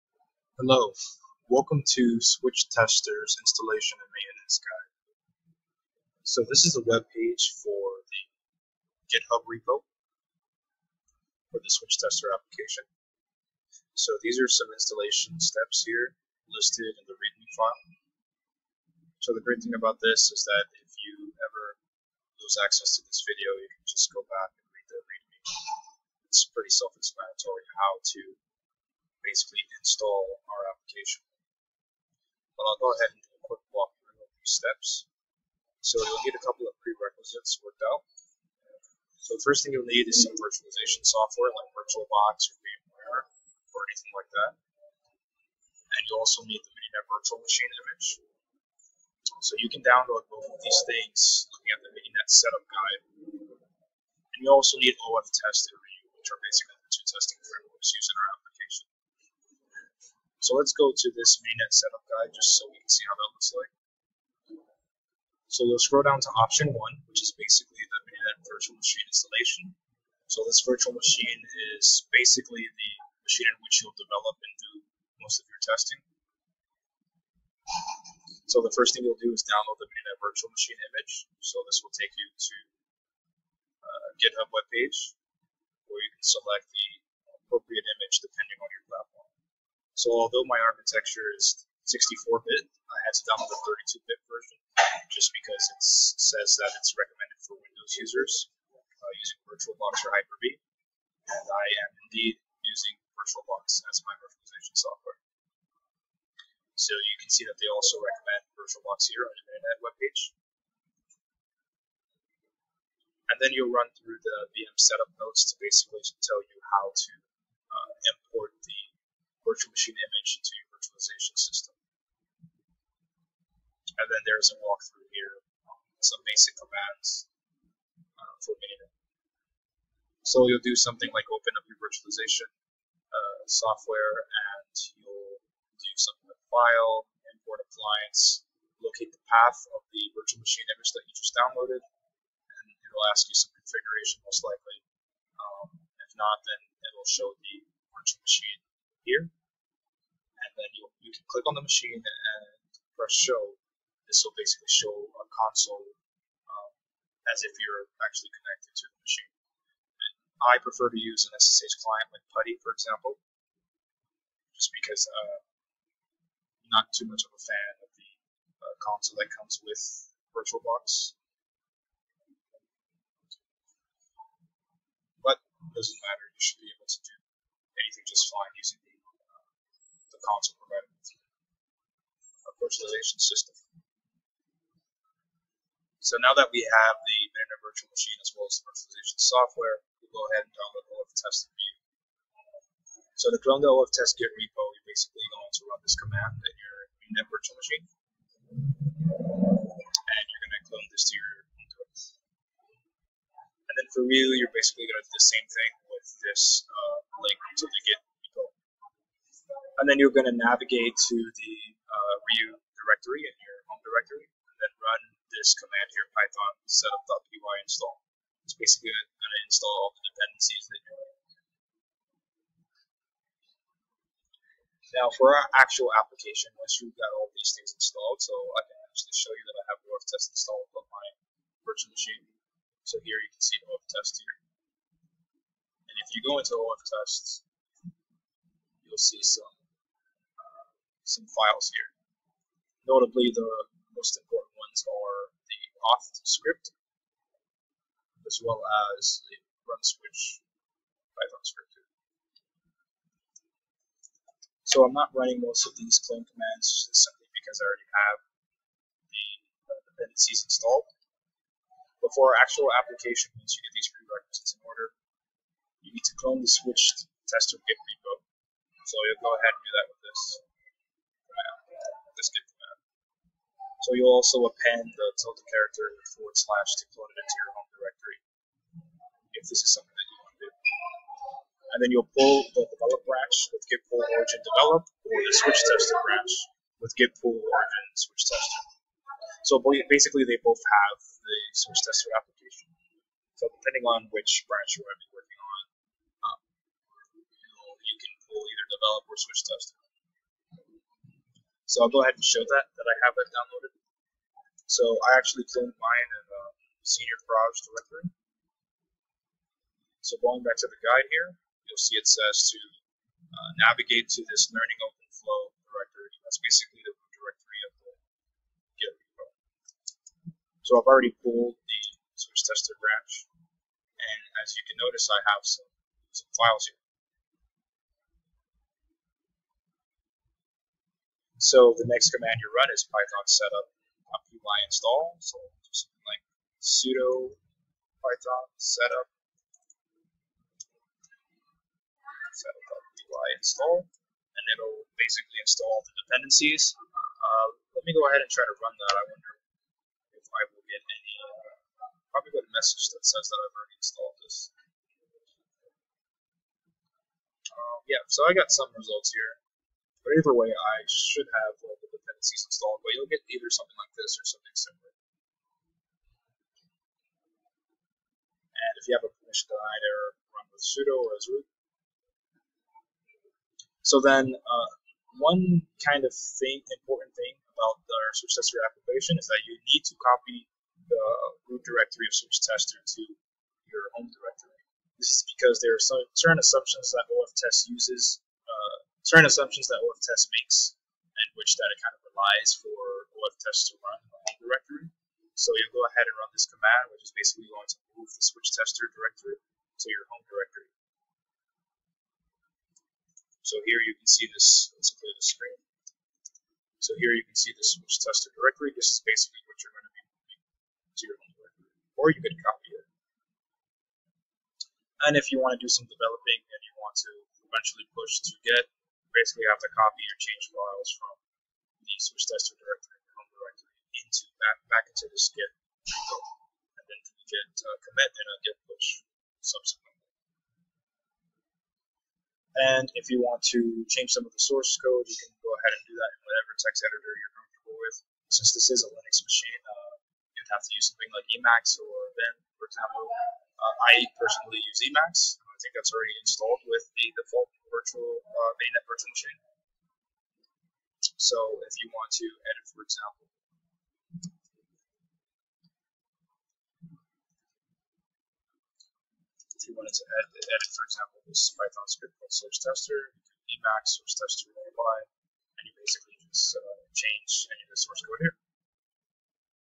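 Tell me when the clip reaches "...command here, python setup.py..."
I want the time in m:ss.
3:35.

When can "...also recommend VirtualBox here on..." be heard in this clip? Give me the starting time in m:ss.
1:47.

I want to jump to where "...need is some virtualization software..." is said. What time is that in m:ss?
0:39.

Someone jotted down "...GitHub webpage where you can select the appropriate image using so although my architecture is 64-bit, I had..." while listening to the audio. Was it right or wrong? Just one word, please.
wrong.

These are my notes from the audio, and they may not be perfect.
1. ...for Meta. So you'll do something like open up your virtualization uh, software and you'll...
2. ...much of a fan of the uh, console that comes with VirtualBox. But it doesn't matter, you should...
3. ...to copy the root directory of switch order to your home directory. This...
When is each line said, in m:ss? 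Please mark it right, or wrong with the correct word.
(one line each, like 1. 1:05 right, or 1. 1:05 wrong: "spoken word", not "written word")
1. 2:08 right
2. 2:47 right
3. 6:19 wrong: "tester", not "order".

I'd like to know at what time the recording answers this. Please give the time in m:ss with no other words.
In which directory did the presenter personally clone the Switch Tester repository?
5:06.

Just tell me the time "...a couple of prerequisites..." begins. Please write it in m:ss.
0:36.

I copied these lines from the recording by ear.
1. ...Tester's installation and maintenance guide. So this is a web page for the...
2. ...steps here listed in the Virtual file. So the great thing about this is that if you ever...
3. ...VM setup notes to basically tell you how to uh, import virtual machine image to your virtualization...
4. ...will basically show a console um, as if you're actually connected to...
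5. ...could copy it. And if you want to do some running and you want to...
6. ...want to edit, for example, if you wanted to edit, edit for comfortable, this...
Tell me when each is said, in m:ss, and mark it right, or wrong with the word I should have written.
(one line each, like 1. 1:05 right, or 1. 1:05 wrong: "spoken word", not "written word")
1. 0:02 right
2. 0:15 wrong: "README", not "Virtual"
3. 1:54 right
4. 2:34 right
5. 6:52 wrong: "developing", not "running"
6. 7:31 wrong: "example", not "comfortable".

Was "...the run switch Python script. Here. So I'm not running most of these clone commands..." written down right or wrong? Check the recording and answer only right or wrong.
right.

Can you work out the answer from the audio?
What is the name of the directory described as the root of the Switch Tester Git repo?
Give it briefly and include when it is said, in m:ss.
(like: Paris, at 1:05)
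Learning OpenFlow, at 5:14.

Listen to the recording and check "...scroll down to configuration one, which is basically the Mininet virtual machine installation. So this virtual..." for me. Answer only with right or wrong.
wrong.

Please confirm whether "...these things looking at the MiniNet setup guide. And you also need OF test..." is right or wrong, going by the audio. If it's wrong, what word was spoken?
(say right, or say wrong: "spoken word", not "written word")
right.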